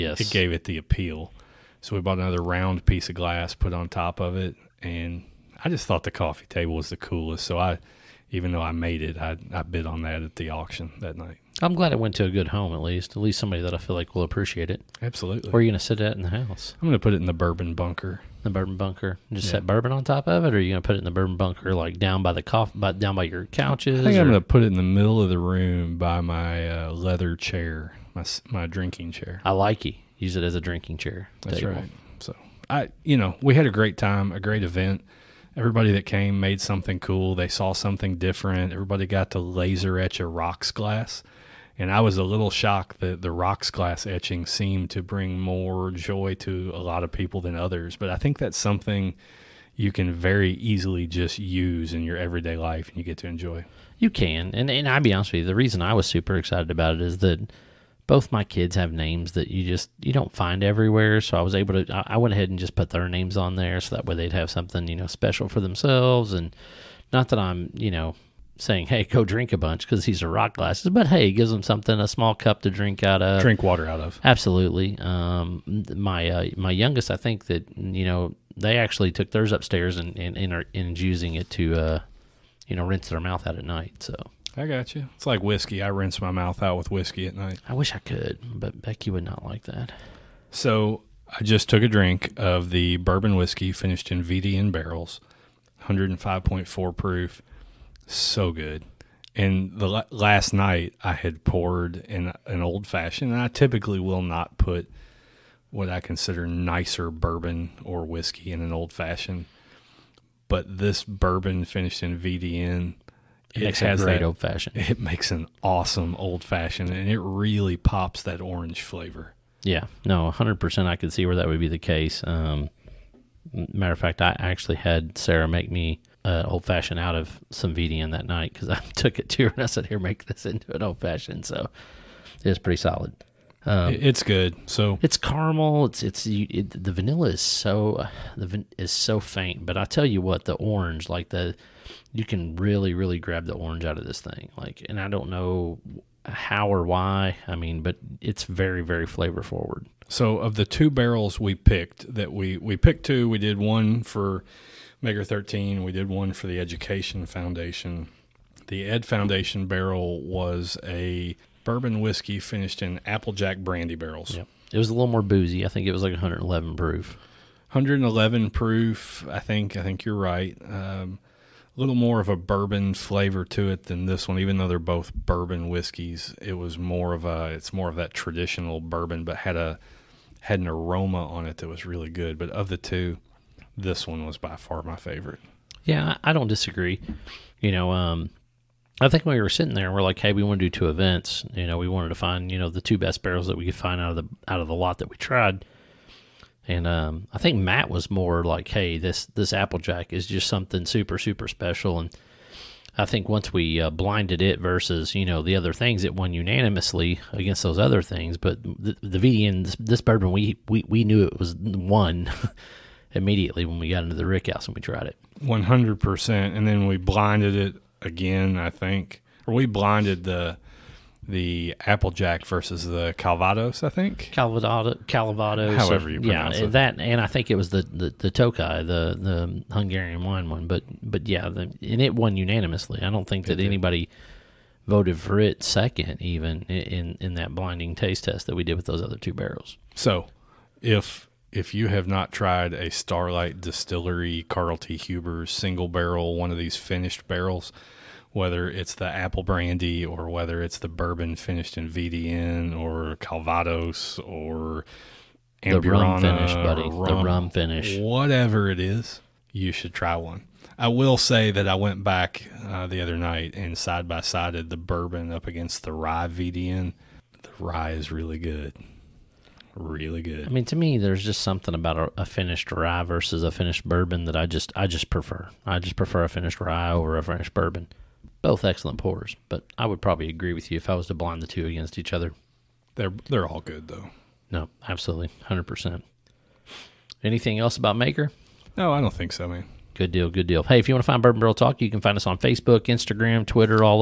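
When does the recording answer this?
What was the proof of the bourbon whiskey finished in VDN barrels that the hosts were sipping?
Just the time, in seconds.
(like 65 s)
95 s.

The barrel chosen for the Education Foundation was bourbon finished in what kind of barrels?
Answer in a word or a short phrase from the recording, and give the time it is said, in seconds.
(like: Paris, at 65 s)
Applejack brandy, at 163 s.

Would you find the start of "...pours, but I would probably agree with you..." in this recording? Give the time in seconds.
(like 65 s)
278 s.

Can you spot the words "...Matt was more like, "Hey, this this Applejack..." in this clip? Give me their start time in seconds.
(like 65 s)
197 s.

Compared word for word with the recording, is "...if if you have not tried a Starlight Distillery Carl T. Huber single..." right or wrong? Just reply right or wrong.
right.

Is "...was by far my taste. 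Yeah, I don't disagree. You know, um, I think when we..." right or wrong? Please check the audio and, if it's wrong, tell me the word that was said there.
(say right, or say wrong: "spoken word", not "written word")
wrong: "favorite", not "taste".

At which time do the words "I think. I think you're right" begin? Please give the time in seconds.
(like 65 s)
169 s.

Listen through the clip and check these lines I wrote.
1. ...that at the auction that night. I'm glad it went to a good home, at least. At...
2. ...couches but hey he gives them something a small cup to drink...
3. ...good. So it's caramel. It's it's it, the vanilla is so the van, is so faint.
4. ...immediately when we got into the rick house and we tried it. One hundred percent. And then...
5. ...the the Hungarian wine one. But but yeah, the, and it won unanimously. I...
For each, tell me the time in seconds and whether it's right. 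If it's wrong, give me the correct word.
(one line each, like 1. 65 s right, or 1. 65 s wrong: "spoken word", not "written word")
1. 10 s right
2. 70 s wrong: "glasses", not "couches"
3. 134 s right
4. 213 s right
5. 228 s right.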